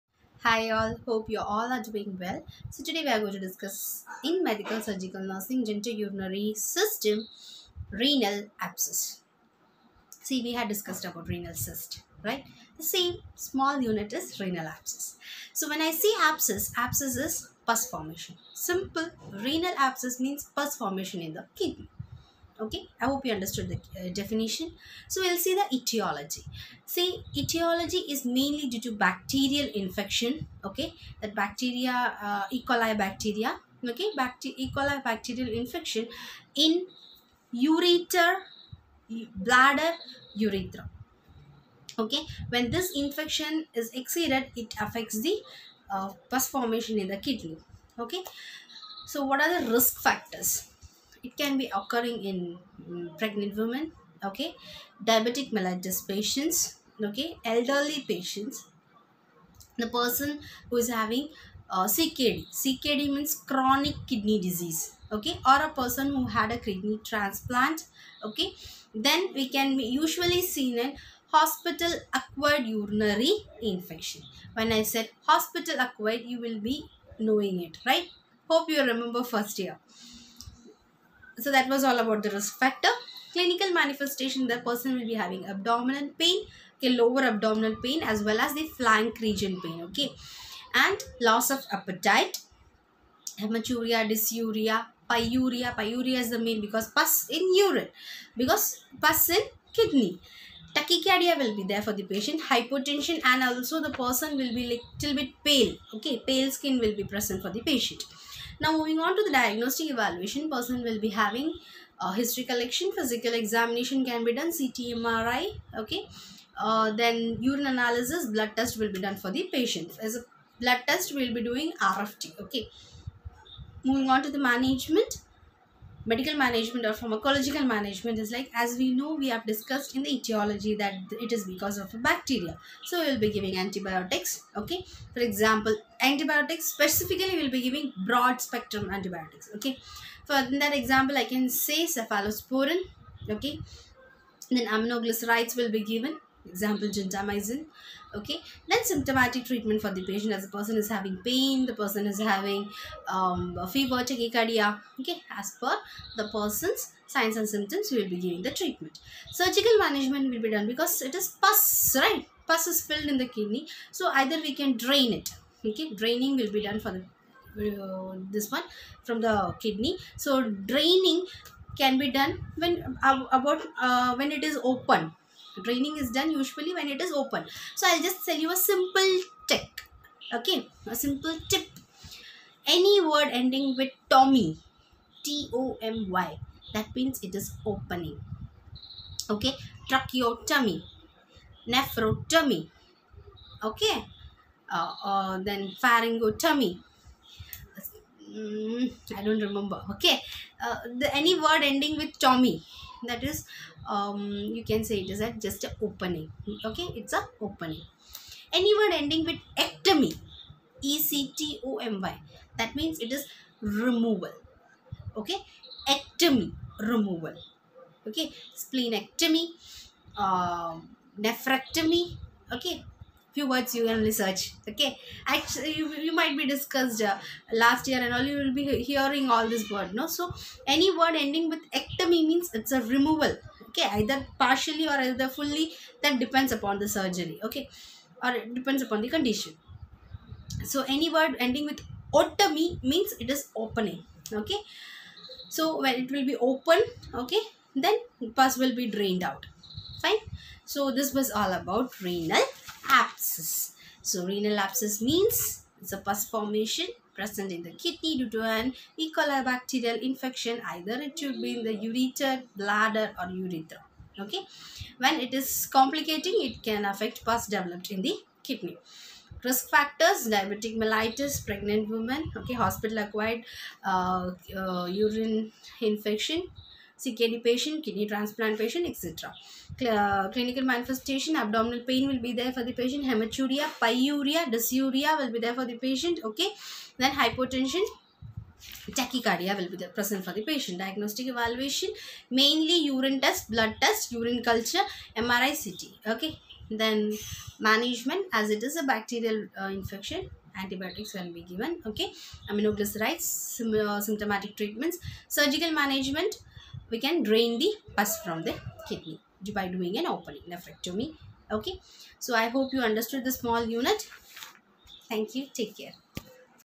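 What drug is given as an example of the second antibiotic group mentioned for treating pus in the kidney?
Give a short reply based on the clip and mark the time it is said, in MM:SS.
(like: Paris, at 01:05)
Gentamicin, at 02:26.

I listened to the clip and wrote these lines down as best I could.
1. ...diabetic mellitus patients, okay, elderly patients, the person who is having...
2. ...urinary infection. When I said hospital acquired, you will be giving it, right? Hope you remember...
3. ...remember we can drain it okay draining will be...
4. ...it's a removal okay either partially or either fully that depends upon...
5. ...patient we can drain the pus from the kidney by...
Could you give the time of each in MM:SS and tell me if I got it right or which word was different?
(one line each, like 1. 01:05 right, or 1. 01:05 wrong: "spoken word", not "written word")
1. 00:55 right
2. 01:12 wrong: "knowing", not "giving"
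3. 02:44 wrong: "either", not "remember"
4. 03:52 right
5. 05:05 wrong: "management", not "patient".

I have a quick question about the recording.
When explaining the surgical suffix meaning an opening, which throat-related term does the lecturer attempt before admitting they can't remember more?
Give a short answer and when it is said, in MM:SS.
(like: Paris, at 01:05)
Pharyngotomy, at 03:15.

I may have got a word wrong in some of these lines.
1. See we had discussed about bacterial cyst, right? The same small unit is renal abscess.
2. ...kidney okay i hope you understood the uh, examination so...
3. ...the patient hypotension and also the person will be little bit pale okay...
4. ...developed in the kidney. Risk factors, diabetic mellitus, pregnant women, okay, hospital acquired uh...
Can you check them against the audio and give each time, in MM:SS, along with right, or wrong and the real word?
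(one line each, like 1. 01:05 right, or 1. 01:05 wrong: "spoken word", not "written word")
1. 00:10 wrong: "renal", not "bacterial"
2. 00:21 wrong: "definition", not "examination"
3. 01:41 right
4. 04:27 right.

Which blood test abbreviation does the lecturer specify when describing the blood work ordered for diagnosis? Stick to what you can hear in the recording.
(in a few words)
RFT.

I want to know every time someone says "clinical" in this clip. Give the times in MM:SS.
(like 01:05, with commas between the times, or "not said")
01:23, 04:40.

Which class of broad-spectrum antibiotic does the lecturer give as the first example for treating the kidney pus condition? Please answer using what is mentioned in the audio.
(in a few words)
Cephalosporin.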